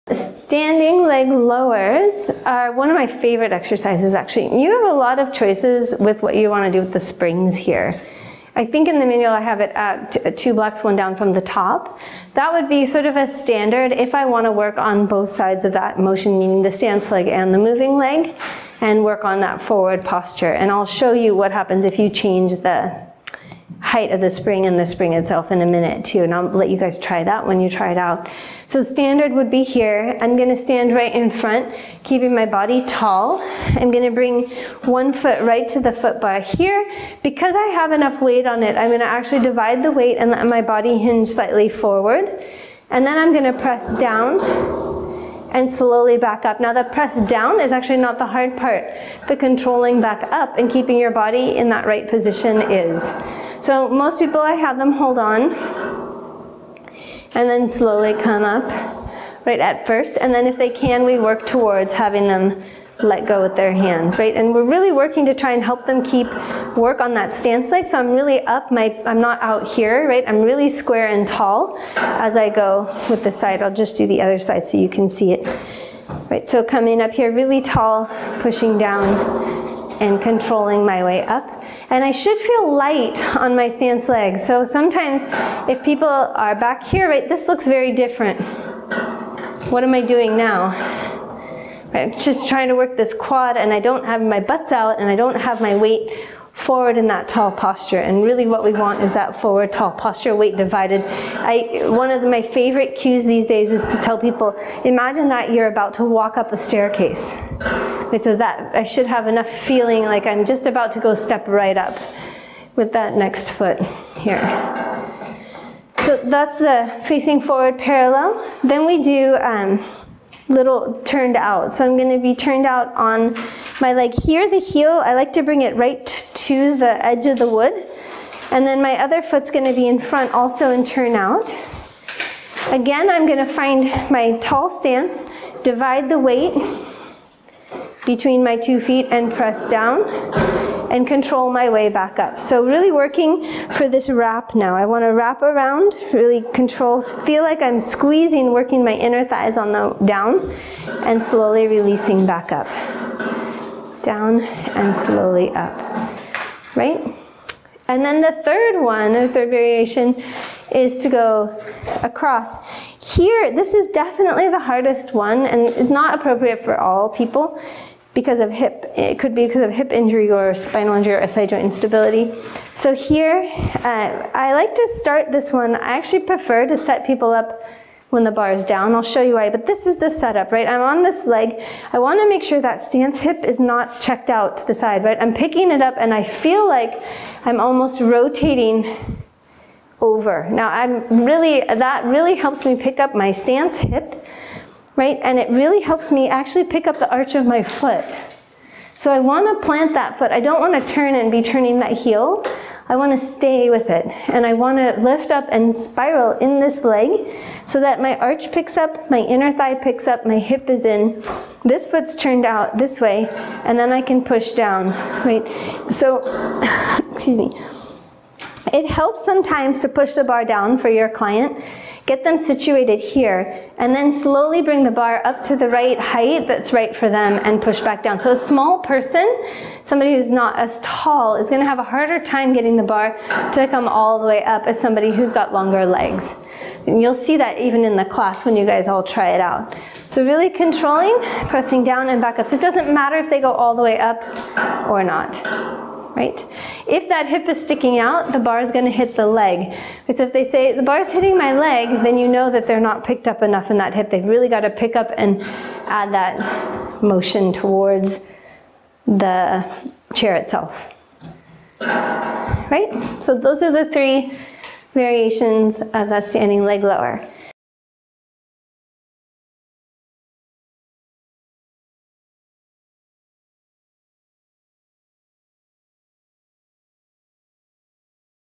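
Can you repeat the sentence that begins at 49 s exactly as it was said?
The controlling back up and keeping your body in that right position is.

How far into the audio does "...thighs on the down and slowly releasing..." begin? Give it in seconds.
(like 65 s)
149 s.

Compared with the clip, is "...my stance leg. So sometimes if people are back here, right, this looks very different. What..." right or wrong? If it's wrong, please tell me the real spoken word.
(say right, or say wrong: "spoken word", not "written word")
right.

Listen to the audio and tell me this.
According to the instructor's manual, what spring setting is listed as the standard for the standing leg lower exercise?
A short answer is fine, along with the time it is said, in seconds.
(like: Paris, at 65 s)
2 blocks, one down from the top, at 10 s.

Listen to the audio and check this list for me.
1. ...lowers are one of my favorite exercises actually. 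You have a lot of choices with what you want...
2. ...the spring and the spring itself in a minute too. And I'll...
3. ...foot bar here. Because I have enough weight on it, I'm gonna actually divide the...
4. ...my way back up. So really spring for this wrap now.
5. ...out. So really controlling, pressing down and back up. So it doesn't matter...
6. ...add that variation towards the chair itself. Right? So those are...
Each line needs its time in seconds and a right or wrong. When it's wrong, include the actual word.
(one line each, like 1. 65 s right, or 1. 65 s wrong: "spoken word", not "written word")
1. 1 s right
2. 24 s right
3. 35 s right
4. 141 s wrong: "working", not "spring"
5. 239 s right
6. 255 s wrong: "motion", not "variation".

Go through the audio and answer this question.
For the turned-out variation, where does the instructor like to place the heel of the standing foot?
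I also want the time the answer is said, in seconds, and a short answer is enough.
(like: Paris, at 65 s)
the edge of the wood, at 126 s.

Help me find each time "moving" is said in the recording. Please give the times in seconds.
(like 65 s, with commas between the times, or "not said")
17 s.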